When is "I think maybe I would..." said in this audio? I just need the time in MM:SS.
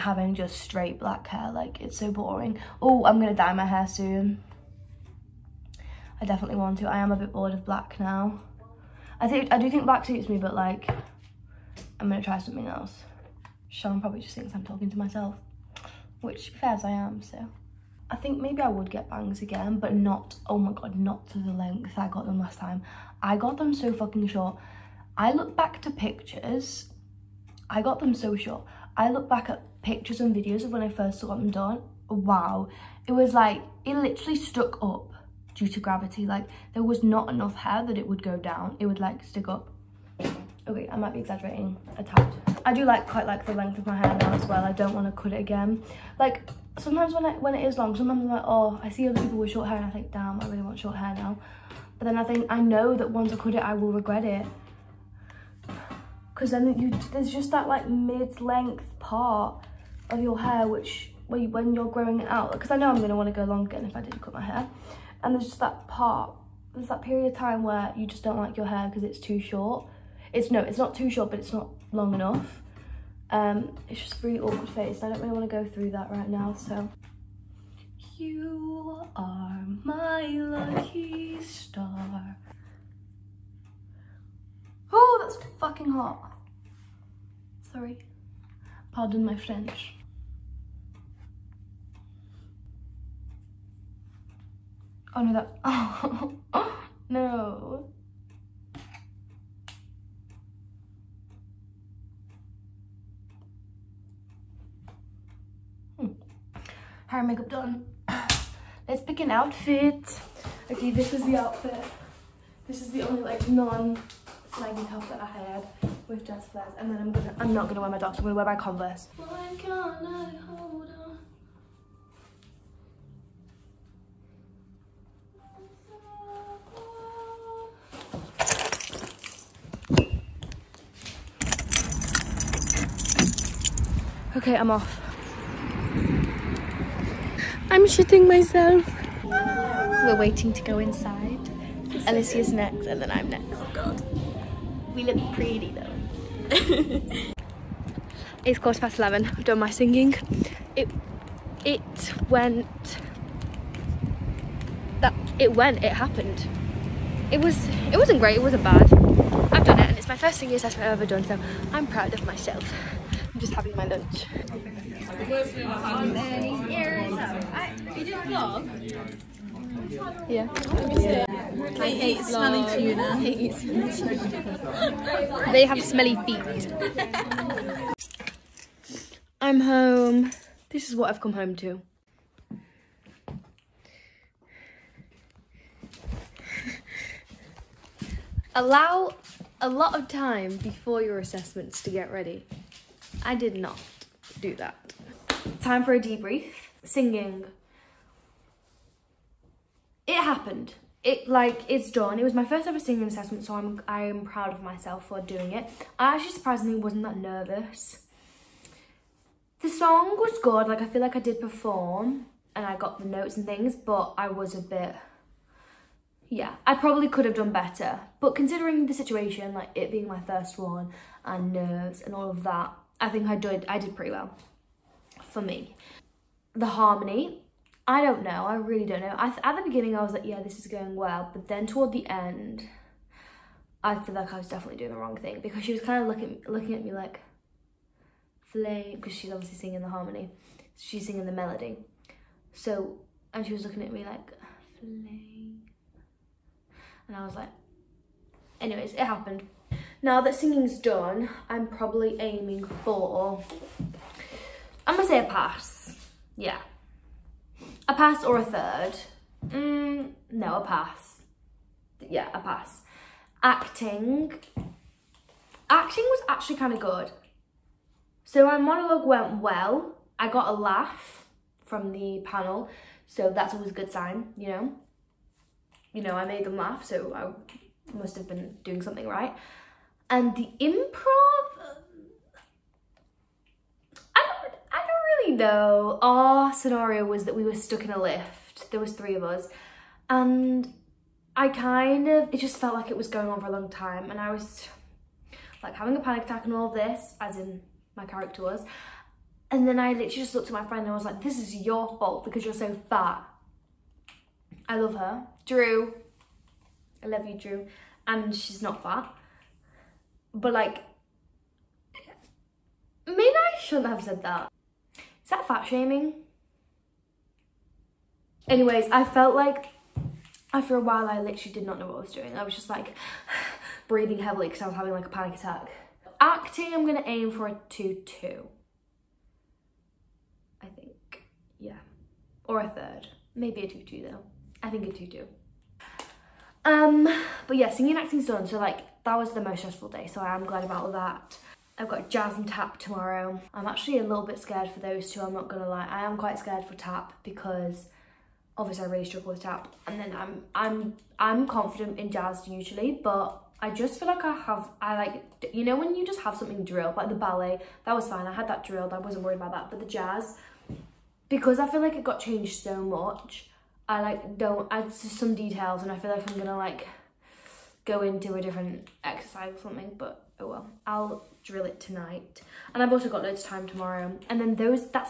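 00:18.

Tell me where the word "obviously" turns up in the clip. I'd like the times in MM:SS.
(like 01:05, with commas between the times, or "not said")
03:59, 05:48.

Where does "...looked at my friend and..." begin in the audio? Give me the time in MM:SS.
05:00.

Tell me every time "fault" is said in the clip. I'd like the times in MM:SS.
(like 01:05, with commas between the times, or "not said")
05:01.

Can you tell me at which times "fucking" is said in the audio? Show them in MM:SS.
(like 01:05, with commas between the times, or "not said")
00:23, 01:25.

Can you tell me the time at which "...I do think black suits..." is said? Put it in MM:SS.
00:09.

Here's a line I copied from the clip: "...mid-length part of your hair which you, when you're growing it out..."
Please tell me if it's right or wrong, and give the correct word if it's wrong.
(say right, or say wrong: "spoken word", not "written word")
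right.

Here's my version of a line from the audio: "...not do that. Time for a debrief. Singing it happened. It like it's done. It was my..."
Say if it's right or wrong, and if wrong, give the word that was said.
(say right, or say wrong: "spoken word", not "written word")
right.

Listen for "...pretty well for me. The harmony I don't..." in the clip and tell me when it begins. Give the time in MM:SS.
03:43.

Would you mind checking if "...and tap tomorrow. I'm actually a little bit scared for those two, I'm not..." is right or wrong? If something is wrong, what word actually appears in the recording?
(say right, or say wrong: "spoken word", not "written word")
right.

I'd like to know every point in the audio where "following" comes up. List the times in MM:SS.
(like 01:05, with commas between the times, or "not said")
not said.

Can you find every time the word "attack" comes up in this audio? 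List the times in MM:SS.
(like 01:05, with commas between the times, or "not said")
04:56, 05:25.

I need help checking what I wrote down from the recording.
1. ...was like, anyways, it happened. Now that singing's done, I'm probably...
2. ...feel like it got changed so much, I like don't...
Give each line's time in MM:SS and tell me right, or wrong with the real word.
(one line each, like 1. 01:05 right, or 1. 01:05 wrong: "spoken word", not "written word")
1. 04:07 right
2. 06:01 right.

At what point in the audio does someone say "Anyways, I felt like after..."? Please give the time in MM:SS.
05:18.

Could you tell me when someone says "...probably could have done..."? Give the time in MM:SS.
03:36.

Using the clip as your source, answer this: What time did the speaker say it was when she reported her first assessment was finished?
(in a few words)
Quarter past 11.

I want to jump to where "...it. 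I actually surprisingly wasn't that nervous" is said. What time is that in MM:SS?
03:25.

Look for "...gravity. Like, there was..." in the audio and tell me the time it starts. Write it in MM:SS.
00:35.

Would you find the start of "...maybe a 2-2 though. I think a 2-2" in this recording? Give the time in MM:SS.
05:33.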